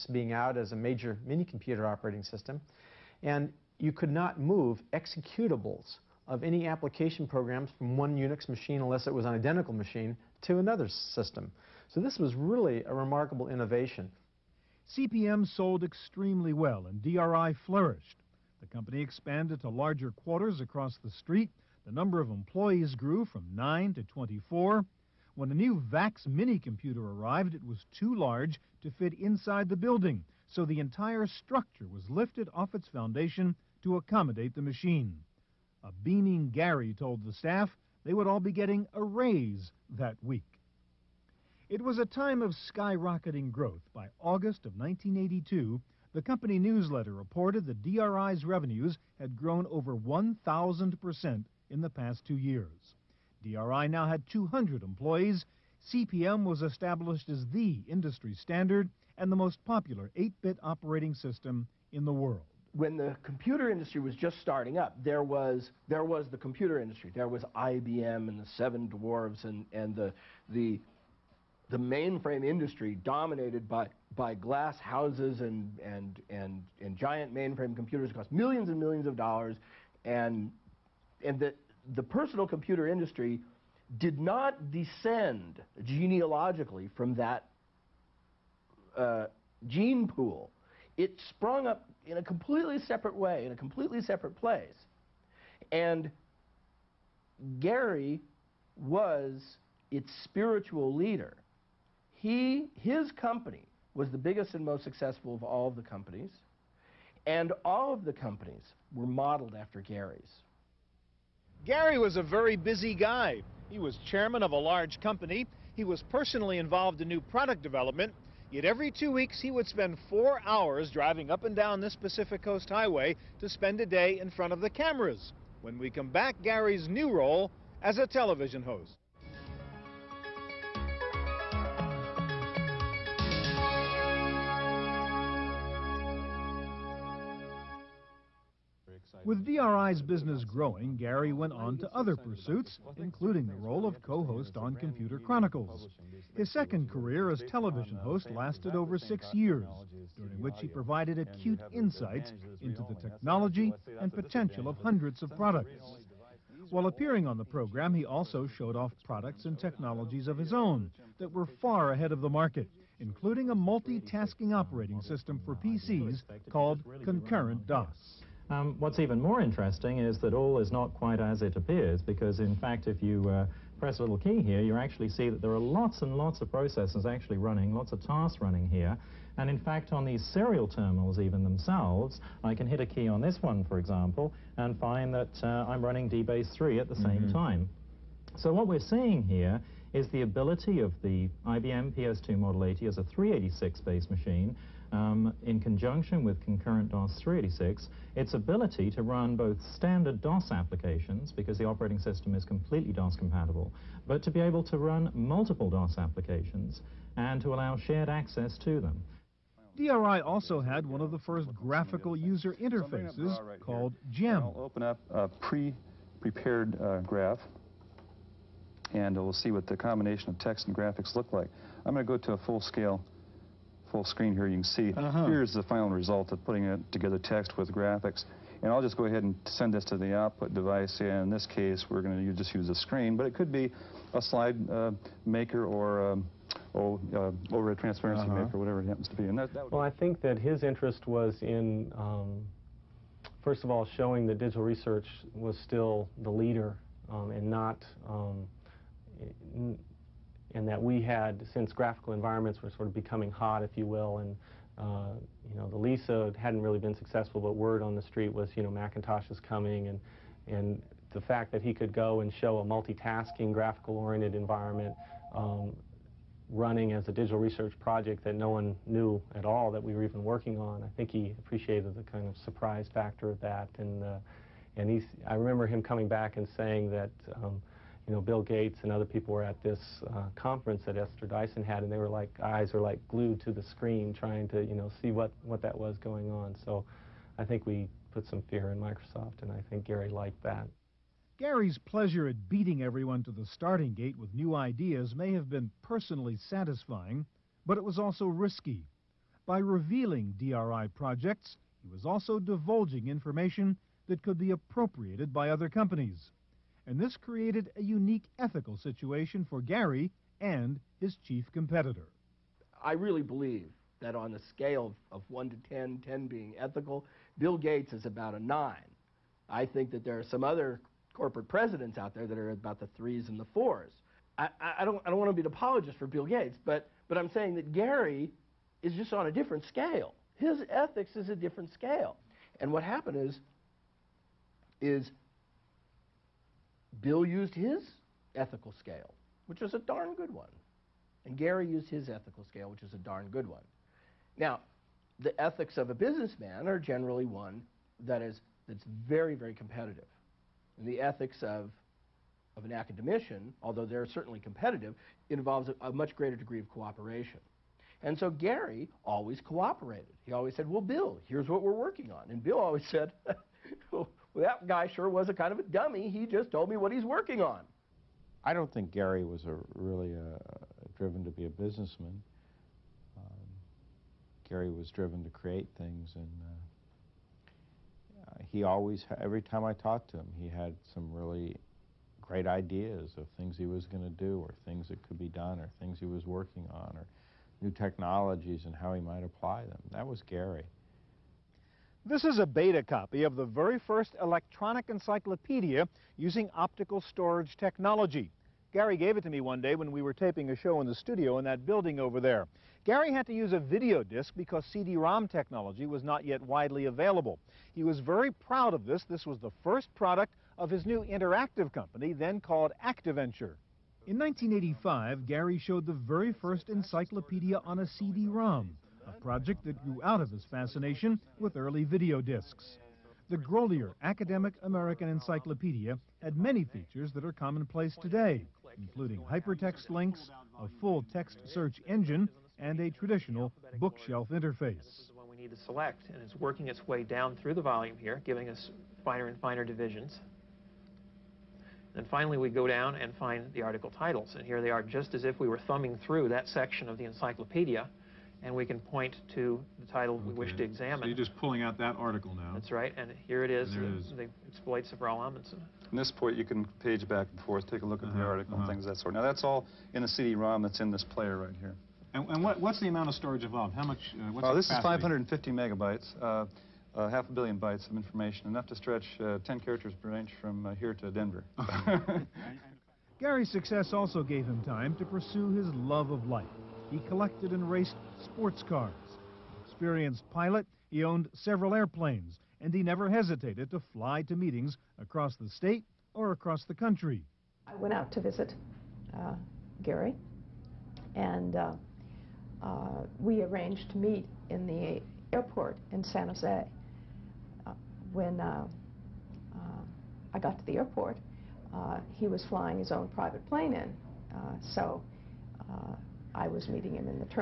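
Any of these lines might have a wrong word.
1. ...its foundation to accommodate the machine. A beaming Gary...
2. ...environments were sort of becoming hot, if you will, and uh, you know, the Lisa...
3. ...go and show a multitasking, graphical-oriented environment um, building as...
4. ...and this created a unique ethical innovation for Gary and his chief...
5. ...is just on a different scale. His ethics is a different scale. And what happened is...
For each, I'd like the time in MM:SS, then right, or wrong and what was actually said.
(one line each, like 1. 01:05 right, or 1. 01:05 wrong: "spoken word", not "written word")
1. 00:32 right
2. 04:12 right
3. 04:21 wrong: "running", not "building"
4. 05:06 wrong: "situation", not "innovation"
5. 05:28 right.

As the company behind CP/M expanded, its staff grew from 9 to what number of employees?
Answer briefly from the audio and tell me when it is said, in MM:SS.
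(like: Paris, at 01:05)
24, at 00:24.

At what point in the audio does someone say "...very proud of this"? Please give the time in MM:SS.
06:47.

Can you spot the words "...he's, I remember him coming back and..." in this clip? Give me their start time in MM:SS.
04:34.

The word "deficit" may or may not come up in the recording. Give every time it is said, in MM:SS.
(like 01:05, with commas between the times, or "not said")
not said.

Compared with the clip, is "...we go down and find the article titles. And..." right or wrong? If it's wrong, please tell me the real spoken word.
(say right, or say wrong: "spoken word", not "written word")
right.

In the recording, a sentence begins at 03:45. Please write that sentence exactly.
here's the final result of putting it together text with graphics.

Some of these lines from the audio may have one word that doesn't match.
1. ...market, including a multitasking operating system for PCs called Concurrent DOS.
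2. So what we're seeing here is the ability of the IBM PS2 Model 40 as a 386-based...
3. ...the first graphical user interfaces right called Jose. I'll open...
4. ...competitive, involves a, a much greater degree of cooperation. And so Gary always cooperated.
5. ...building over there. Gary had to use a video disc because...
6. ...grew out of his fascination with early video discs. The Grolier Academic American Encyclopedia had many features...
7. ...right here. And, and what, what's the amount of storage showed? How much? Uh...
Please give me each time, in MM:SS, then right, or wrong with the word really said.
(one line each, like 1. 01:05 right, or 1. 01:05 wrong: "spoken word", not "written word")
1. 02:42 right
2. 03:08 wrong: "80", not "40"
3. 03:31 wrong: "GEM", not "Jose"
4. 05:54 right
5. 06:41 right
6. 06:59 right
7. 07:41 wrong: "involved", not "showed".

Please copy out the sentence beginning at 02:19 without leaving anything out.
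With DRI's business growing, Gary went on to other pursuits, including the role of co-host on Computer Chronicles.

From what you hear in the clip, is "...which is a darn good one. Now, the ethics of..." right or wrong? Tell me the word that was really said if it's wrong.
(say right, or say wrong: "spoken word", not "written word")
right.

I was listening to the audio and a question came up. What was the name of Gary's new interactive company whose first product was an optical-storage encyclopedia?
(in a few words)
ActiVenture.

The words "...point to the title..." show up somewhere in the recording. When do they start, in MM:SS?
07:28.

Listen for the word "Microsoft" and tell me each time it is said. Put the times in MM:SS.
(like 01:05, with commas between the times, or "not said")
04:48.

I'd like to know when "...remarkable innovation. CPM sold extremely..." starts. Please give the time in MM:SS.
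00:12.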